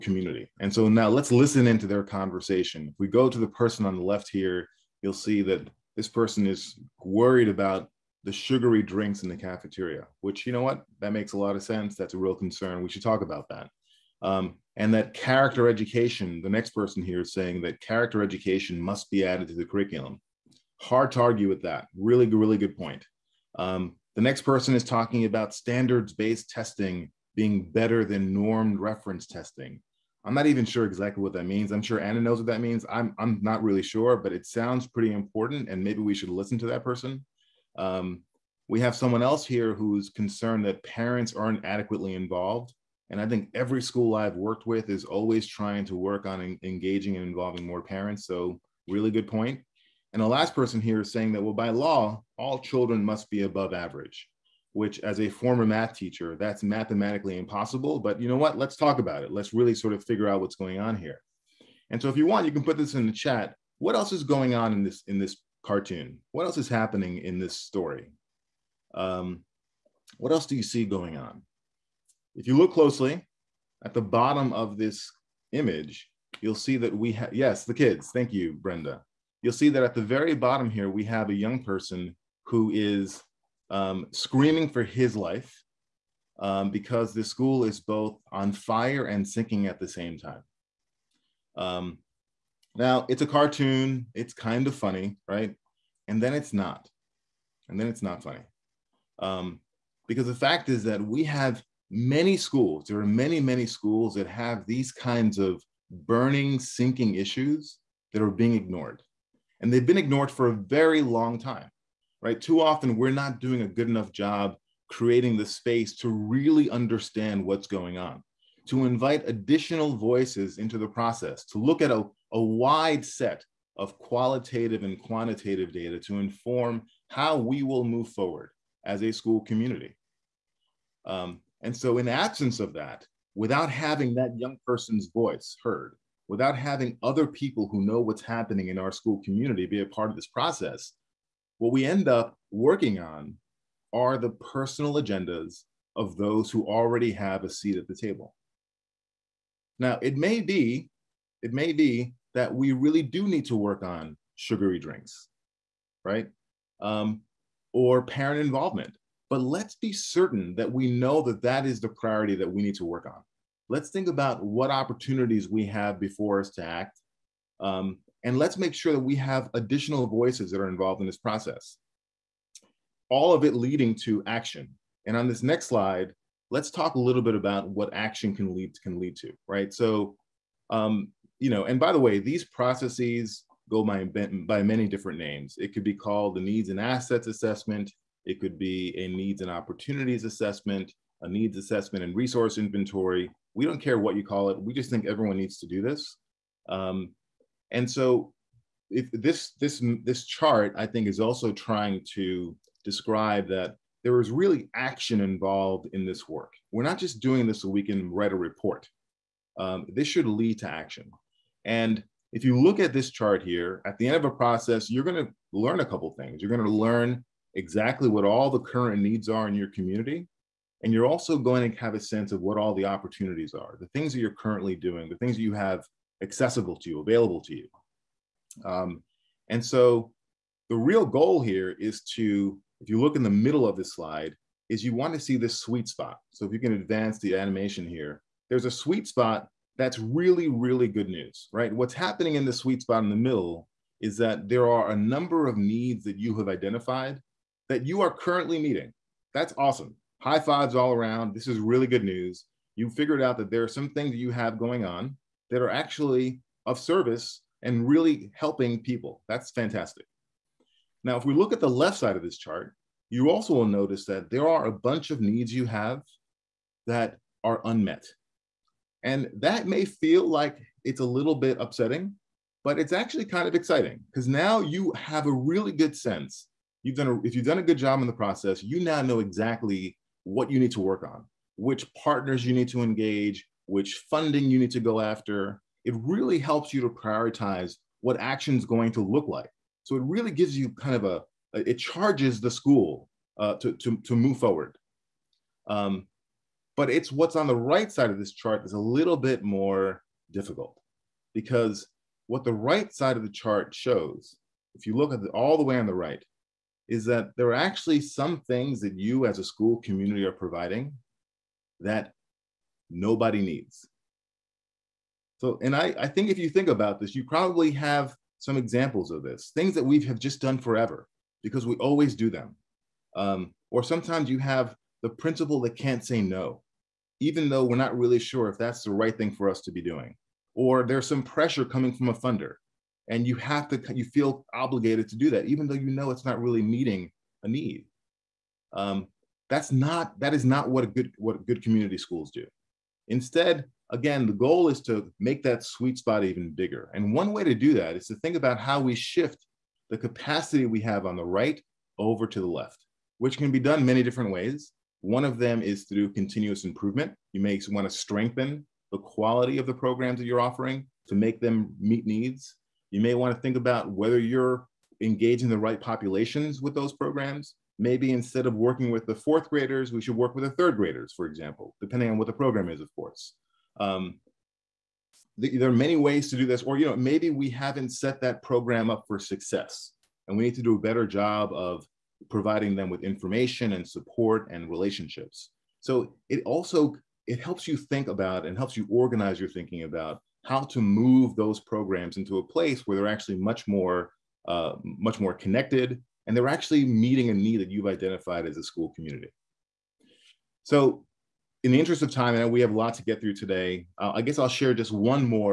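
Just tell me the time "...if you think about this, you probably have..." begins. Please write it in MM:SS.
05:16.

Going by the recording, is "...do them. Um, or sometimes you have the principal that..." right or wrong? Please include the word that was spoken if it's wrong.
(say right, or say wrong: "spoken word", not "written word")
right.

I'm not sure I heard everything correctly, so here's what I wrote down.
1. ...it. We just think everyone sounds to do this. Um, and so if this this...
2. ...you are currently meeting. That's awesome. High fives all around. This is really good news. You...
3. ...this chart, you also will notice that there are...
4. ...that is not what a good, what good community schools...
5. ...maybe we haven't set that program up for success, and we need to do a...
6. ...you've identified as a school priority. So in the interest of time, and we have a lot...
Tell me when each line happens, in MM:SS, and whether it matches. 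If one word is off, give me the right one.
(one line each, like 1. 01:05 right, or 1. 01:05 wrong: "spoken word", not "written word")
1. 03:14 wrong: "needs", not "sounds"
2. 04:07 right
3. 04:22 right
4. 05:40 right
5. 06:16 right
6. 06:37 wrong: "community", not "priority".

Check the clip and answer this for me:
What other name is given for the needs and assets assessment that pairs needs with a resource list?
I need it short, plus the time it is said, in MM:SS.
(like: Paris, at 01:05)
needs assessment and resource inventory, at 03:11.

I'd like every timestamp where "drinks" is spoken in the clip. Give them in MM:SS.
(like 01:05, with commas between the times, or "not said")
00:08, 02:34.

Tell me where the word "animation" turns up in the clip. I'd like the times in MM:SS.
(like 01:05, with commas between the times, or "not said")
03:57.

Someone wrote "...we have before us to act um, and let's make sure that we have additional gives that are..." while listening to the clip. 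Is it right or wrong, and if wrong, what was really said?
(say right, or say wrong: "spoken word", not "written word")
wrong: "voices", not "gives".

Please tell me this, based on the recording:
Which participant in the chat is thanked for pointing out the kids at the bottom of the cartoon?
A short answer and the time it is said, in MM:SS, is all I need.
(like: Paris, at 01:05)
Brenda, at 01:18.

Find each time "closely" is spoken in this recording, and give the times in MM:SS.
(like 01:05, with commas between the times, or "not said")
01:12.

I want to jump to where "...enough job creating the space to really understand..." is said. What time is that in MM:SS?
01:53.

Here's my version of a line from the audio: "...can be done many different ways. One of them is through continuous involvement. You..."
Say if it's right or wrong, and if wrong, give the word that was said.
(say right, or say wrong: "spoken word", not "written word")
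wrong: "improvement", not "involvement".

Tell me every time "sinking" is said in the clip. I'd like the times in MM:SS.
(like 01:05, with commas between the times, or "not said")
01:29, 01:46.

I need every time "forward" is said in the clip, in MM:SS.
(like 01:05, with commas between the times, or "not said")
02:08, 04:54.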